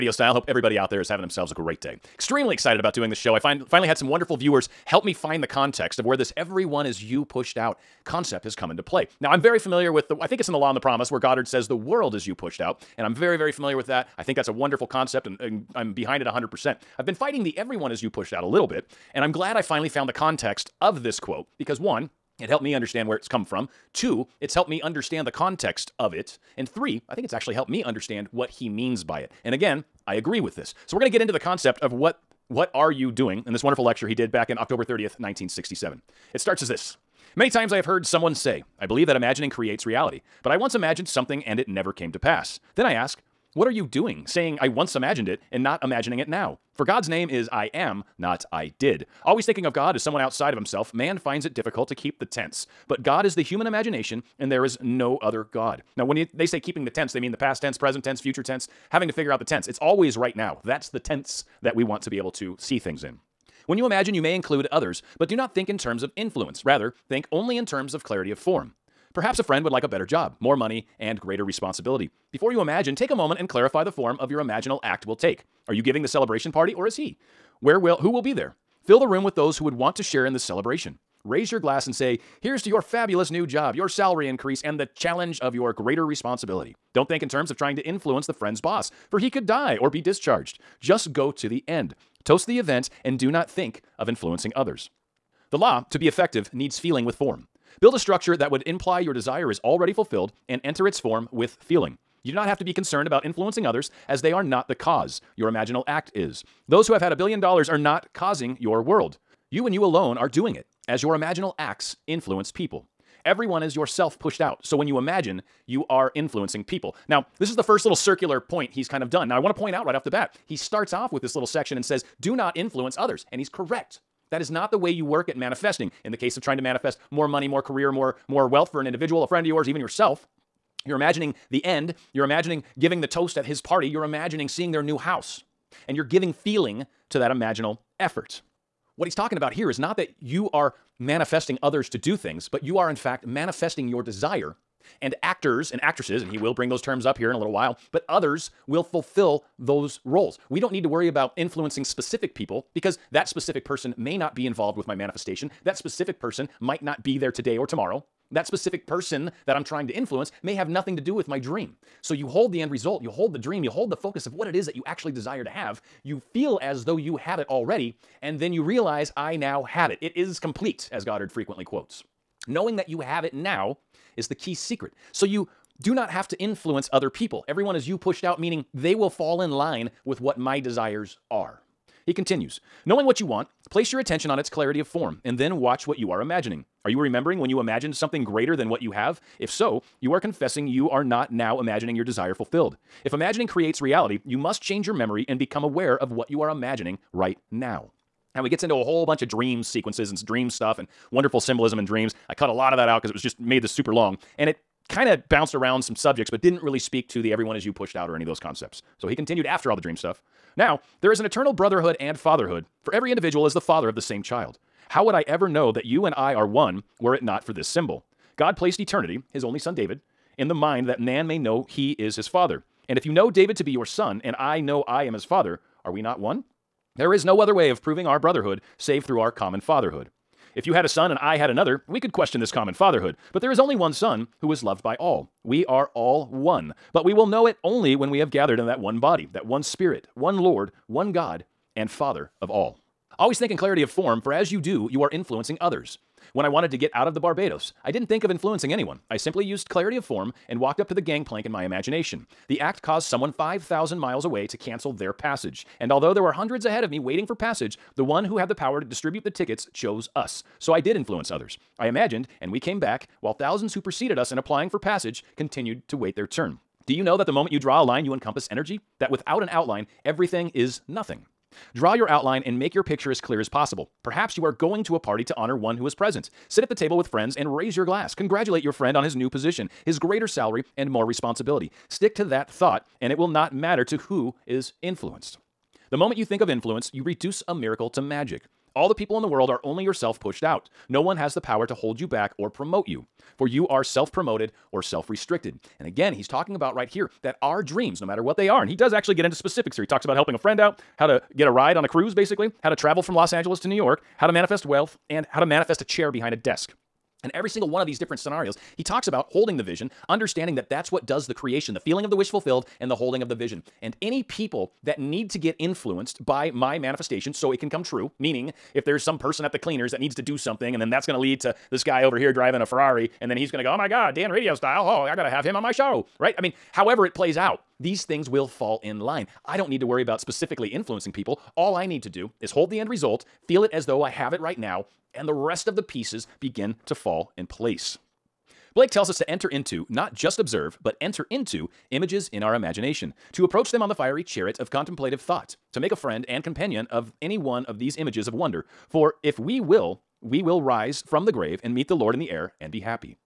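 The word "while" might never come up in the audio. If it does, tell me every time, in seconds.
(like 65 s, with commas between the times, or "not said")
147 s, 263 s.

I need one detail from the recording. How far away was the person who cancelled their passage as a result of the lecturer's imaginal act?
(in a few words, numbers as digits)
5,000 miles.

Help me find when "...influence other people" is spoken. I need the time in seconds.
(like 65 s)
176 s.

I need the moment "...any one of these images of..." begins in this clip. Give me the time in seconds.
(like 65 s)
347 s.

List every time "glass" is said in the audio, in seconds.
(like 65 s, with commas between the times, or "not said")
81 s, 277 s.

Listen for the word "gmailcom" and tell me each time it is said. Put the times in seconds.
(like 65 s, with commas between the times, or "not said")
not said.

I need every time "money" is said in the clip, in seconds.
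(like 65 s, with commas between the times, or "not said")
70 s, 127 s.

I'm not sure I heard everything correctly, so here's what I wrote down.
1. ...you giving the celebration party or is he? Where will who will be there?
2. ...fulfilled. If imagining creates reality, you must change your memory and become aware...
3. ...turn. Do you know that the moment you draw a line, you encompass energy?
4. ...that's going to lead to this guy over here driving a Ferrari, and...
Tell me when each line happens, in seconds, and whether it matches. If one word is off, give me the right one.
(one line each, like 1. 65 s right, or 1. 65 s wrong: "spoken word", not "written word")
1. 75 s right
2. 192 s right
3. 266 s right
4. 320 s right.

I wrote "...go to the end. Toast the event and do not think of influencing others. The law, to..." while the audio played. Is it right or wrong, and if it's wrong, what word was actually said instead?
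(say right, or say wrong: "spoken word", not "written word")
right.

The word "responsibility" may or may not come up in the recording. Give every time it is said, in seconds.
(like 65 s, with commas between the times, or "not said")
71 s, 86 s, 281 s.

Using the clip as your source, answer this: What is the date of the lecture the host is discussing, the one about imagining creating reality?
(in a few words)
October 30th, 1967.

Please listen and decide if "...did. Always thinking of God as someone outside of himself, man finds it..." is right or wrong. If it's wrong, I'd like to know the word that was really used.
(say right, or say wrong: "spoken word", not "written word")
right.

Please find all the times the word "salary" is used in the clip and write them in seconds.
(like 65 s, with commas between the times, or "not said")
83 s, 280 s.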